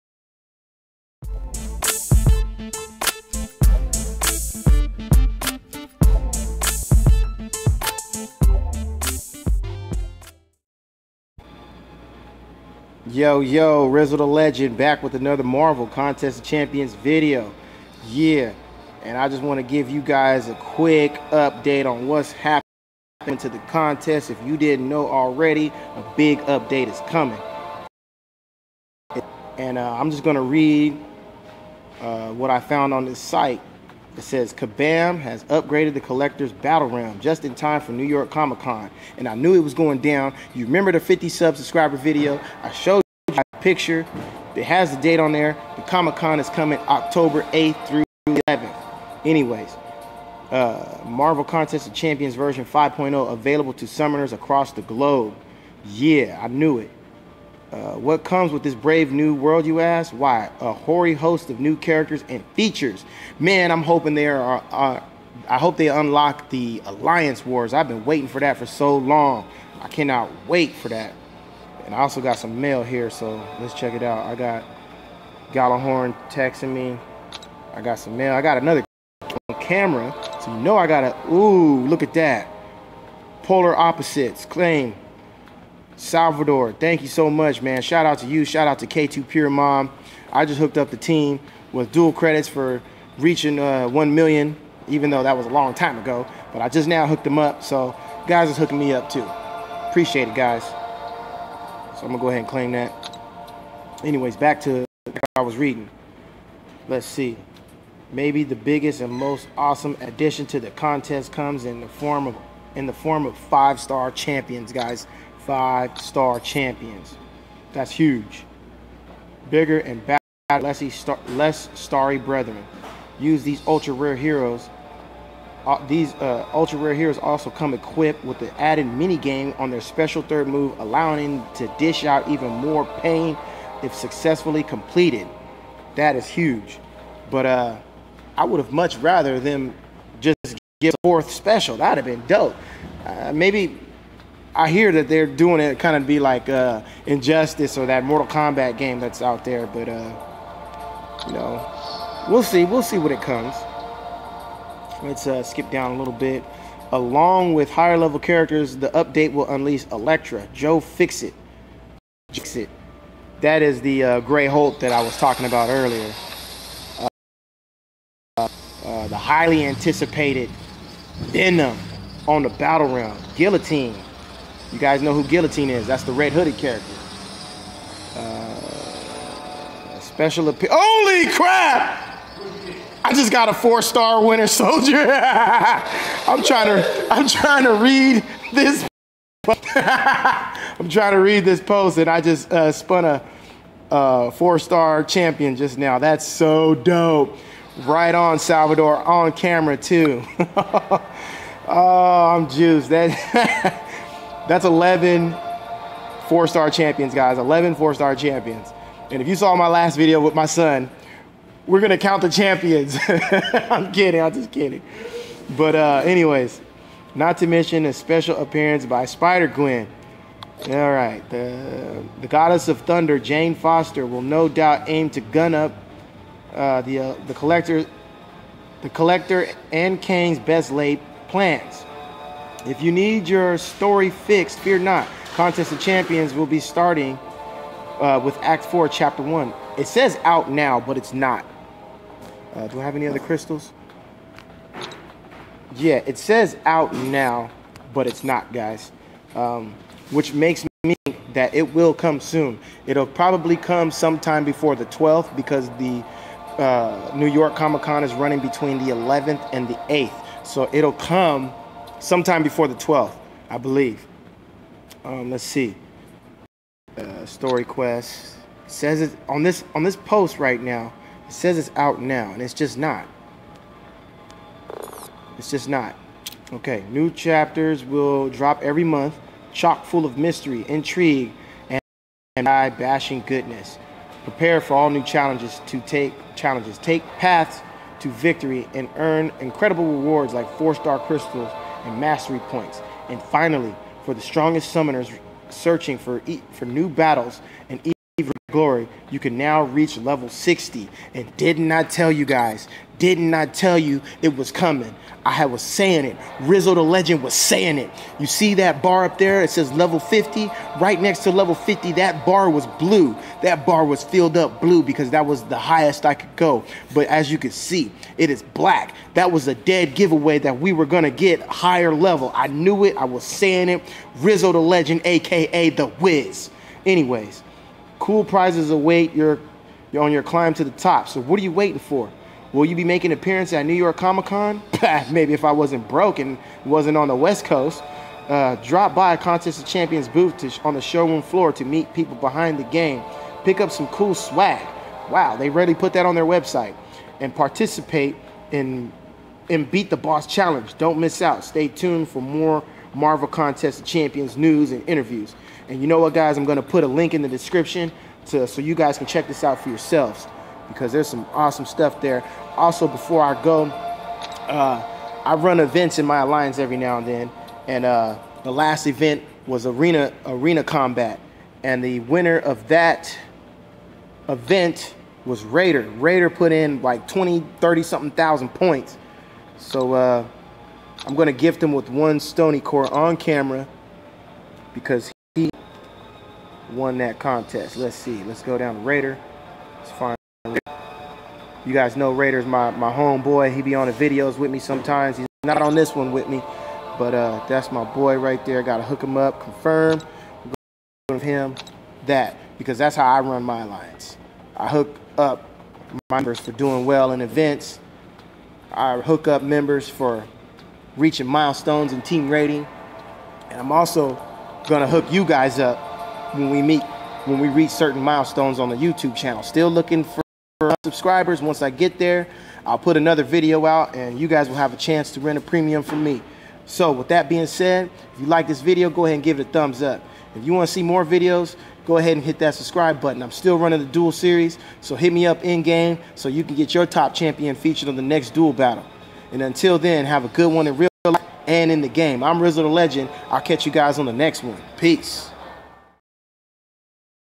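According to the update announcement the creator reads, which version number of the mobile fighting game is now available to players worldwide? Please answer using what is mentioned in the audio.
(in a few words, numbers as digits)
5.0.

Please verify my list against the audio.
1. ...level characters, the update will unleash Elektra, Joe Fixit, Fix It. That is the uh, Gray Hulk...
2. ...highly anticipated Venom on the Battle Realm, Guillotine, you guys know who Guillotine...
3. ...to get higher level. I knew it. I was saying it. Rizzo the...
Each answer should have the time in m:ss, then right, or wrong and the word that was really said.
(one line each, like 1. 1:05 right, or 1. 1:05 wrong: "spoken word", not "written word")
1. 2:37 right
2. 2:49 right
3. 5:21 right.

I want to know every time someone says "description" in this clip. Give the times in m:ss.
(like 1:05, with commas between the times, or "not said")
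5:57.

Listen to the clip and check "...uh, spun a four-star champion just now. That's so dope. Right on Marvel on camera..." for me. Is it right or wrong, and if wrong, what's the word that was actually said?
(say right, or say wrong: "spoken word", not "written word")
wrong: "Salvador", not "Marvel".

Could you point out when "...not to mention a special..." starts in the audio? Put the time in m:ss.
3:37.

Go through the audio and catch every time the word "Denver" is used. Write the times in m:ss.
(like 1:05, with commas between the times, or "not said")
not said.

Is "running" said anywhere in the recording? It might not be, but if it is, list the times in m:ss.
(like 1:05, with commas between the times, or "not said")
4:18, 7:13.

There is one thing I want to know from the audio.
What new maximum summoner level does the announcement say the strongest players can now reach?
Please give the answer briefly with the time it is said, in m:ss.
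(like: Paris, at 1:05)
60, at 4:59.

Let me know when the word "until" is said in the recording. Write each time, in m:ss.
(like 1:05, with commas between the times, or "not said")
7:19.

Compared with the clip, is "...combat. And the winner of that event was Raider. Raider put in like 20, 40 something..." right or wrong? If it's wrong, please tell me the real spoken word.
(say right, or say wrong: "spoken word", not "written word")
wrong: "30", not "40".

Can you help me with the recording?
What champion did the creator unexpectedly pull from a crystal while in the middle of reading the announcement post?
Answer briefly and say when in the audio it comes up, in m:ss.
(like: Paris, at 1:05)
Winter Soldier, at 3:04.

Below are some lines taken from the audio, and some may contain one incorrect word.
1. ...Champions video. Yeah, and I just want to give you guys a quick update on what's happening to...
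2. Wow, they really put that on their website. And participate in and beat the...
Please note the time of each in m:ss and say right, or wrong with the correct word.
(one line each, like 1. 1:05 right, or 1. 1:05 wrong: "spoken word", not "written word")
1. 0:16 right
2. 5:45 right.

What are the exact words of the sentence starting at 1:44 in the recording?
Anyways, back to what I was reading.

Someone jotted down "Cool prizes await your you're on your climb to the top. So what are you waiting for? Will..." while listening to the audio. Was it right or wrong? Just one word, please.
right.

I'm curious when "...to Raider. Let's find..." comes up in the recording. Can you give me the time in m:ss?
6:28.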